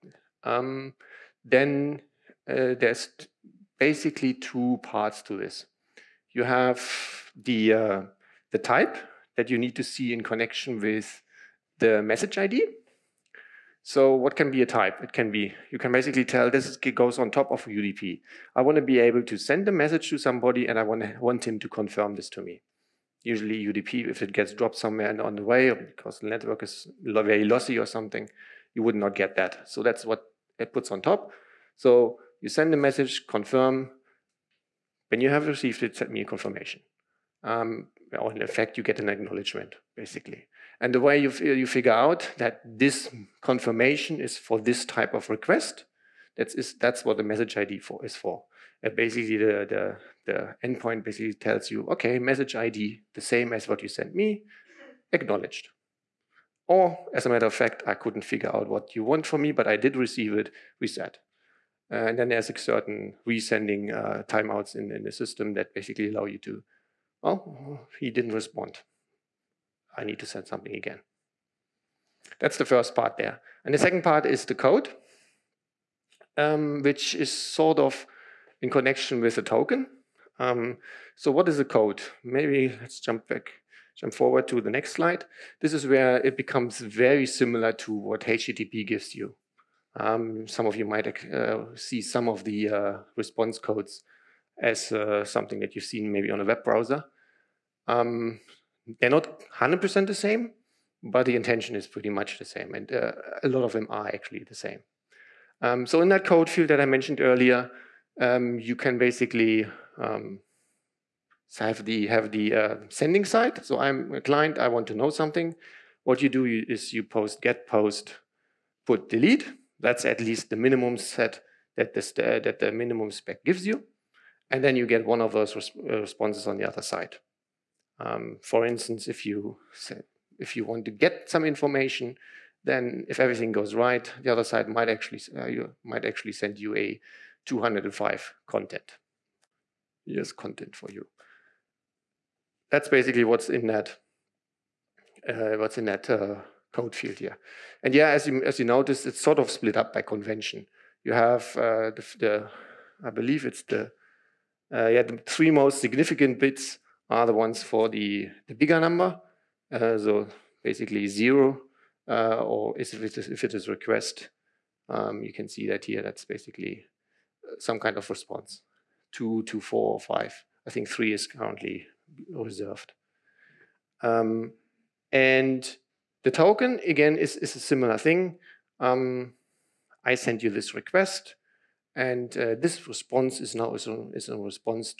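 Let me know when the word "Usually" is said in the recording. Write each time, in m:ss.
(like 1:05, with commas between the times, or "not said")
0:23.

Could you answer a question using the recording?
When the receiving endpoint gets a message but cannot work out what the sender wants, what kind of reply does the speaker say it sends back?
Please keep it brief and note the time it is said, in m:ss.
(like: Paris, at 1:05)
Reset, at 1:00.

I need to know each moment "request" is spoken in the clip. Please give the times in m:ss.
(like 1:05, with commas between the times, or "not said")
0:45, 2:43, 3:00.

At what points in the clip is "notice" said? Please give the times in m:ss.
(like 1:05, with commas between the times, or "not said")
2:28.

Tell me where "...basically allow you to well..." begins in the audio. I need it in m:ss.
1:05.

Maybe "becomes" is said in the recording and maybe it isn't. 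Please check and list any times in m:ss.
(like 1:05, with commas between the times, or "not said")
1:26.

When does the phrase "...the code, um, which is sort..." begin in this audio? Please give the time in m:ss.
1:14.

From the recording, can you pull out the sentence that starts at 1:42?
And uh, a lot of them are actually the same.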